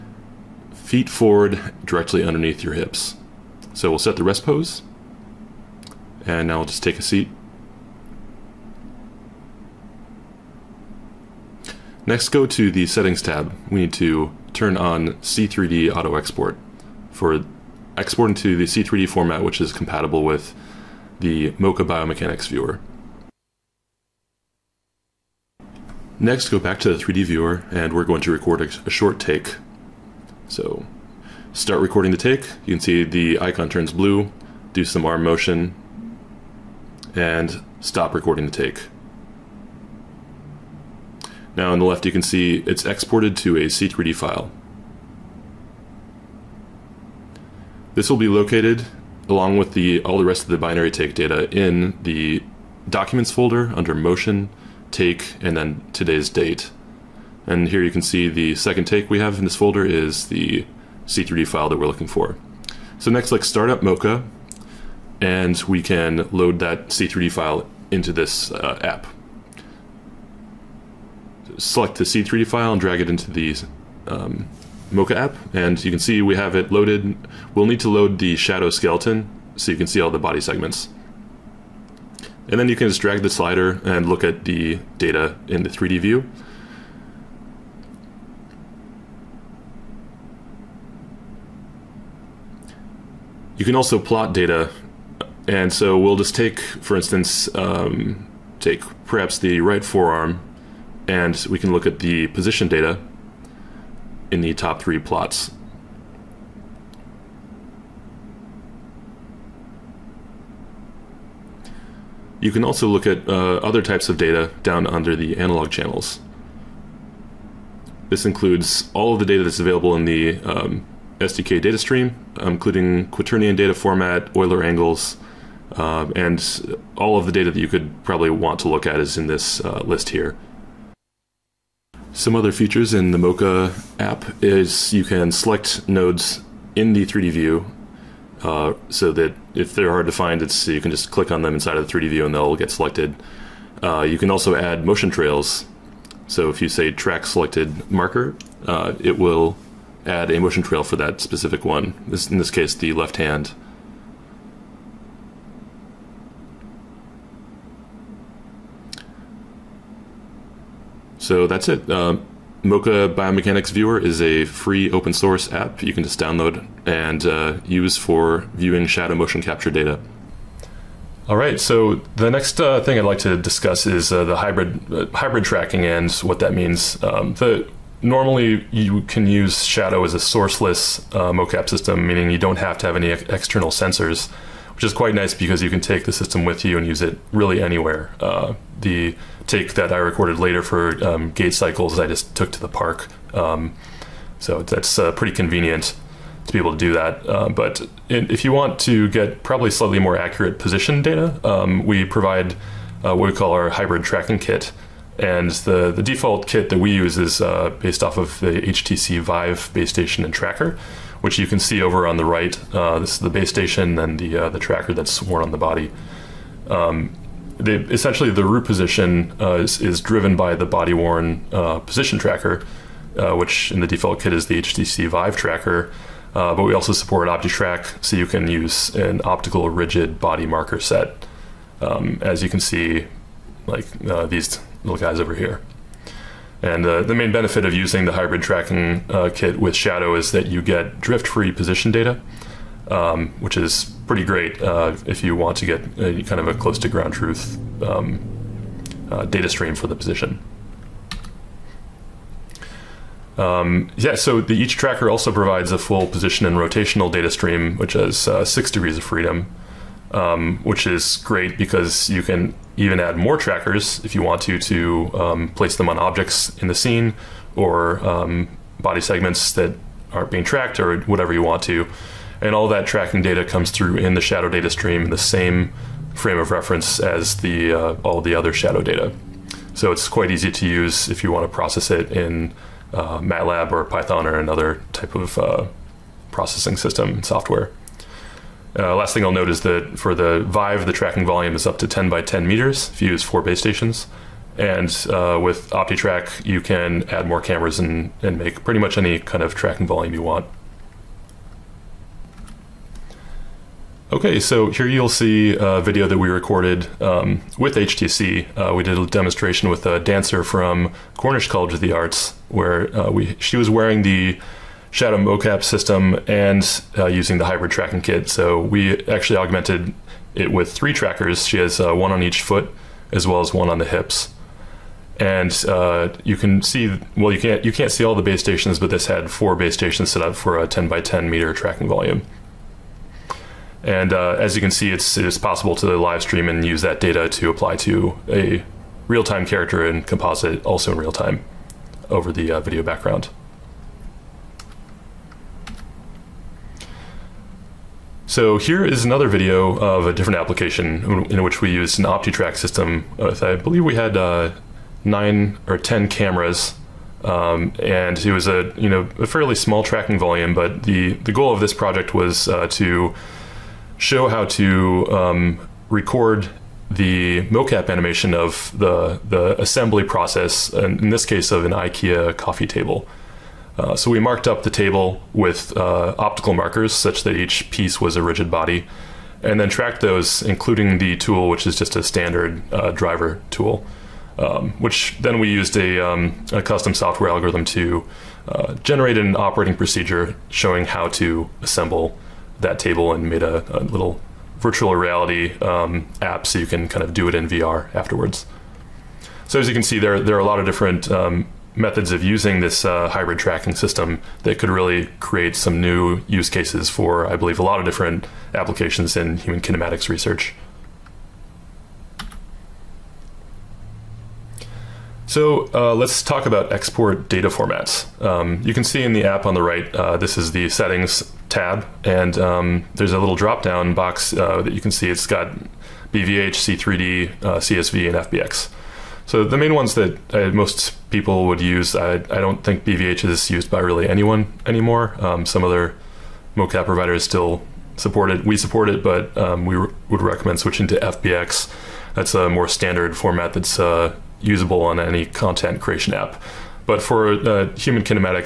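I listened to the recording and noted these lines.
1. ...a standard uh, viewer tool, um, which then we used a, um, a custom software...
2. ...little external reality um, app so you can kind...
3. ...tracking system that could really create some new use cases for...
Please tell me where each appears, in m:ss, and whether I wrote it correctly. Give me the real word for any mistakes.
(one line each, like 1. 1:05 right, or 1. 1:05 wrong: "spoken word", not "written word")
1. 6:21 wrong: "driver", not "viewer"
2. 6:33 wrong: "virtual", not "external"
3. 6:43 right.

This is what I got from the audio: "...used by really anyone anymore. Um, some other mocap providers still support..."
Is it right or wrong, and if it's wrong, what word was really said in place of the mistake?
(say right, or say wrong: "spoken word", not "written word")
right.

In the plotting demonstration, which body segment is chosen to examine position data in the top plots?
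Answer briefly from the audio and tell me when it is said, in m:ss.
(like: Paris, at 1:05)
right forearm, at 1:39.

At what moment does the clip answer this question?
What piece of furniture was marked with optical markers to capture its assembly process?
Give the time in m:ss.
6:11.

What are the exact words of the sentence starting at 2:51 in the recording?
All right, so the next uh, thing I'd like to discuss is uh, the hybrid uh, hybrid tracking and what that means.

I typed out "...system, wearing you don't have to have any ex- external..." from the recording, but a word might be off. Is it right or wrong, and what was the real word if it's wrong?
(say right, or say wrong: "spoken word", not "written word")
wrong: "meaning", not "wearing".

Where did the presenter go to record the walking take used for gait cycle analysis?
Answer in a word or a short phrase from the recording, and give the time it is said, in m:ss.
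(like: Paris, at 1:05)
the park, at 3:12.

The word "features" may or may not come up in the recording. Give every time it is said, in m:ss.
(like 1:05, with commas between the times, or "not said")
2:12.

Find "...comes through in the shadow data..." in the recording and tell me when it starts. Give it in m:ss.
4:33.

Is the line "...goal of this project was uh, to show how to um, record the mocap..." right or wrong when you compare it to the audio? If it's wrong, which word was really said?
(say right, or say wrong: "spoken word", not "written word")
right.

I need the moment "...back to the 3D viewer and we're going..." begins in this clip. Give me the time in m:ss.
0:26.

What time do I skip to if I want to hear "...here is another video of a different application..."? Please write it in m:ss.
5:48.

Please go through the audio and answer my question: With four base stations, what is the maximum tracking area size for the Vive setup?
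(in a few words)
10 by 10 meters.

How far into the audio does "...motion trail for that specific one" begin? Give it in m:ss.
2:30.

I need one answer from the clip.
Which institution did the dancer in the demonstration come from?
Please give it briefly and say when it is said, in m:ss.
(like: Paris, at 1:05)
Cornish College of the Arts, at 5:11.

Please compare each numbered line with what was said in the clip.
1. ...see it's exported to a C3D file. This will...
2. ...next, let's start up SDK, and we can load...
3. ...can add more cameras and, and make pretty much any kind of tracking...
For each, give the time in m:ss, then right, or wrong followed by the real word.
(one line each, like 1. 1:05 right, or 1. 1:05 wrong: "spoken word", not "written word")
1. 0:42 right
2. 1:03 wrong: "Mokka", not "SDK"
3. 4:56 right.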